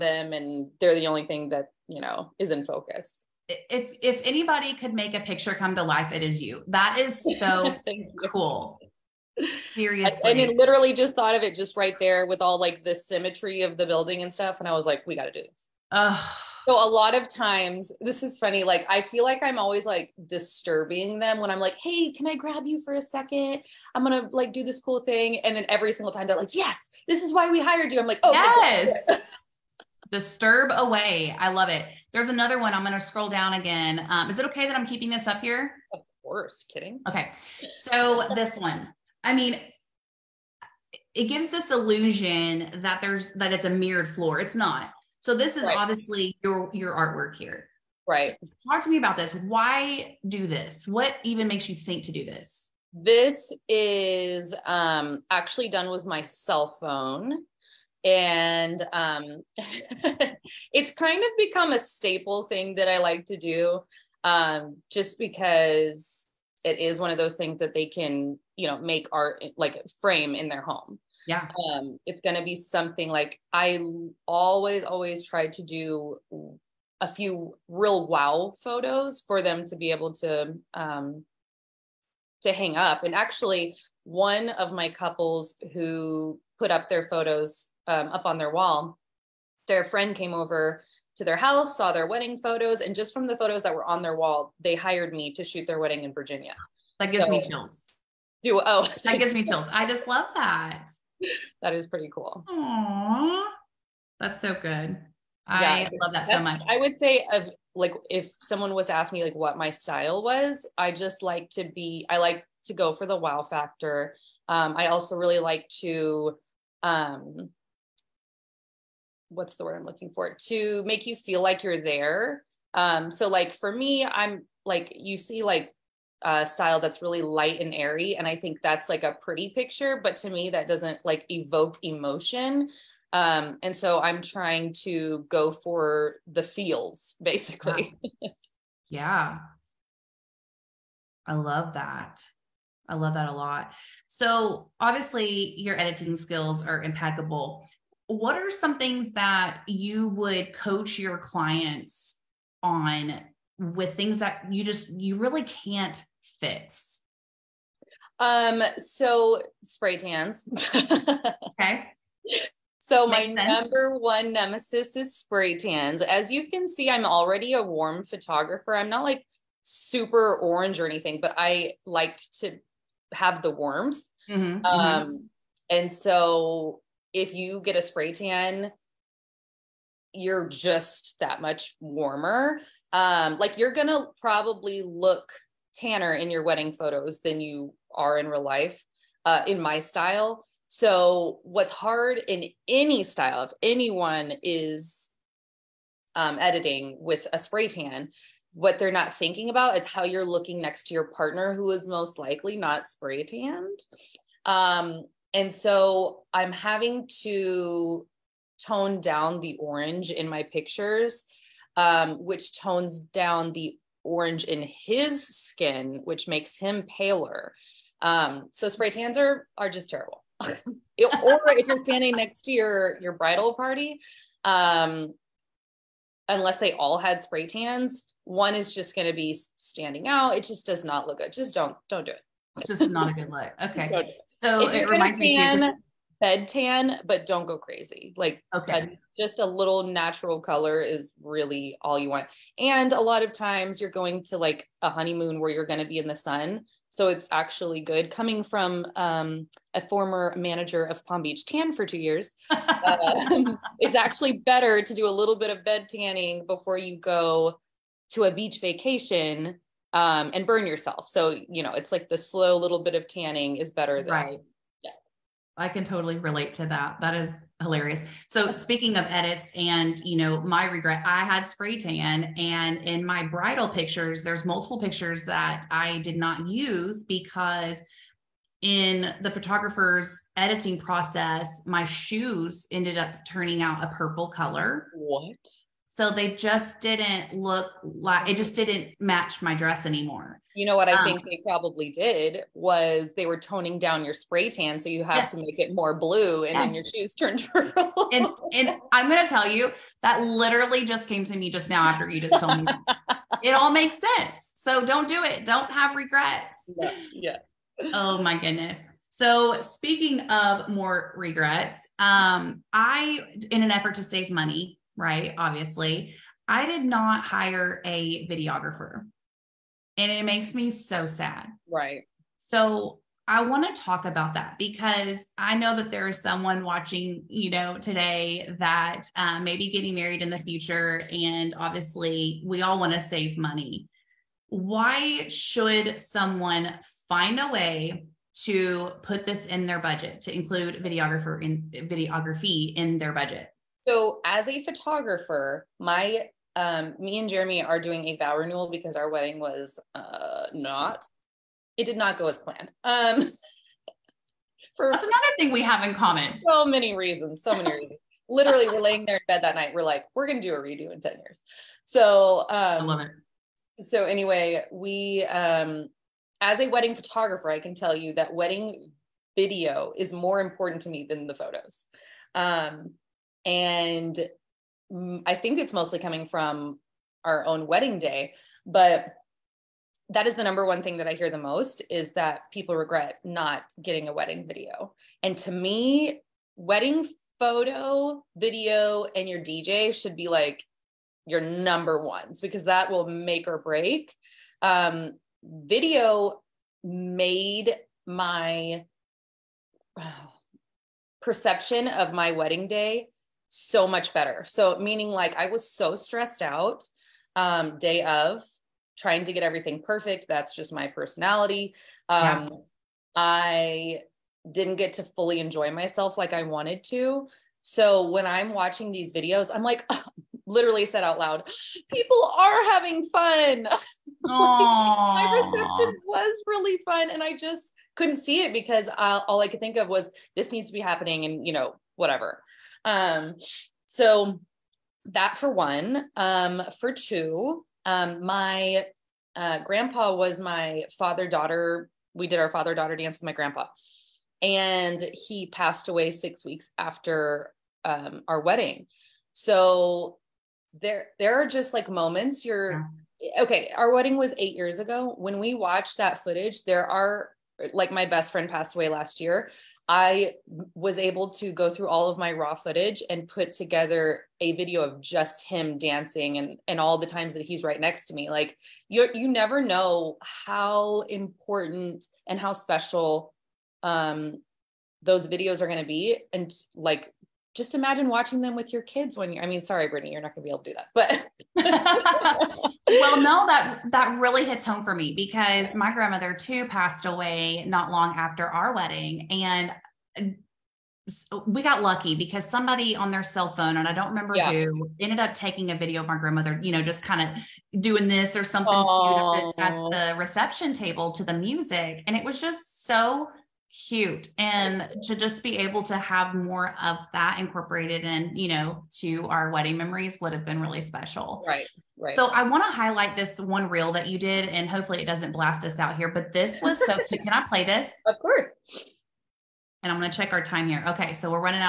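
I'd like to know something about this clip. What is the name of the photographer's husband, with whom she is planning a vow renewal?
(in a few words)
Jeremy.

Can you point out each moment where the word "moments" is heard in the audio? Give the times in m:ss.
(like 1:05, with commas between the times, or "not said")
7:31.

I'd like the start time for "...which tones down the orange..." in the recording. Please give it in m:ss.
3:32.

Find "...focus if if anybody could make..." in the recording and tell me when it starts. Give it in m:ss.
0:02.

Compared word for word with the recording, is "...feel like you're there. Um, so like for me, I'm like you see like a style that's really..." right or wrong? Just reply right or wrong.
right.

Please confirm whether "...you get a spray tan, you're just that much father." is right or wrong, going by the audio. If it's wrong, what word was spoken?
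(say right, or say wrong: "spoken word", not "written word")
wrong: "warmer", not "father".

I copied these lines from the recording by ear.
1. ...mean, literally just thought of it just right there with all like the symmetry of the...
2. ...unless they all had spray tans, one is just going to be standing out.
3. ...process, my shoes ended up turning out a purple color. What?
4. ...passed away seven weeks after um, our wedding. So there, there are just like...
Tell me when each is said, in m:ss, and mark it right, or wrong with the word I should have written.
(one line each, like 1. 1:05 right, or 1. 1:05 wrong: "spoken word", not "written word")
1. 0:10 right
2. 3:46 right
3. 4:40 right
4. 7:25 wrong: "six", not "seven".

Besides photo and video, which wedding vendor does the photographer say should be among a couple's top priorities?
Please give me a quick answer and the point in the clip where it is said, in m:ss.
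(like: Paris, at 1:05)
DJ, at 6:29.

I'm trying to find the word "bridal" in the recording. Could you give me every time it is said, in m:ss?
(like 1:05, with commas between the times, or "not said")
3:43, 4:33.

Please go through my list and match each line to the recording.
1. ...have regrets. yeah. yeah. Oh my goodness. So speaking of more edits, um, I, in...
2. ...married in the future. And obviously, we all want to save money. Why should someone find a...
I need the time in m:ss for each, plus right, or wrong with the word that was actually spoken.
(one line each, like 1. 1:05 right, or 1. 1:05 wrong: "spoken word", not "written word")
1. 5:05 wrong: "regrets", not "edits"
2. 5:29 right.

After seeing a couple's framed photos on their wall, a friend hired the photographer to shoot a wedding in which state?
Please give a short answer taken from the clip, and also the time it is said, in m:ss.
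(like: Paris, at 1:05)
Virginia, at 1:36.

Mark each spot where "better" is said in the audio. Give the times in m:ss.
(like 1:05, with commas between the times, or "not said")
4:14, 4:23, 6:44.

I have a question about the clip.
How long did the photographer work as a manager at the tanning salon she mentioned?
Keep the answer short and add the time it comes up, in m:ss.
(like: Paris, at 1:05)
2 years, at 4:11.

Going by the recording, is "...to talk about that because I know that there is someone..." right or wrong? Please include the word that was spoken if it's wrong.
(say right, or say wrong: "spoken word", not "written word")
right.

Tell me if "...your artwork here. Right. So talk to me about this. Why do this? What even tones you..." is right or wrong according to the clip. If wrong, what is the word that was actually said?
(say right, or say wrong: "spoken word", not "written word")
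wrong: "makes", not "tones".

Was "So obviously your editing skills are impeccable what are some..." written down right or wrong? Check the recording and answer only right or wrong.
right.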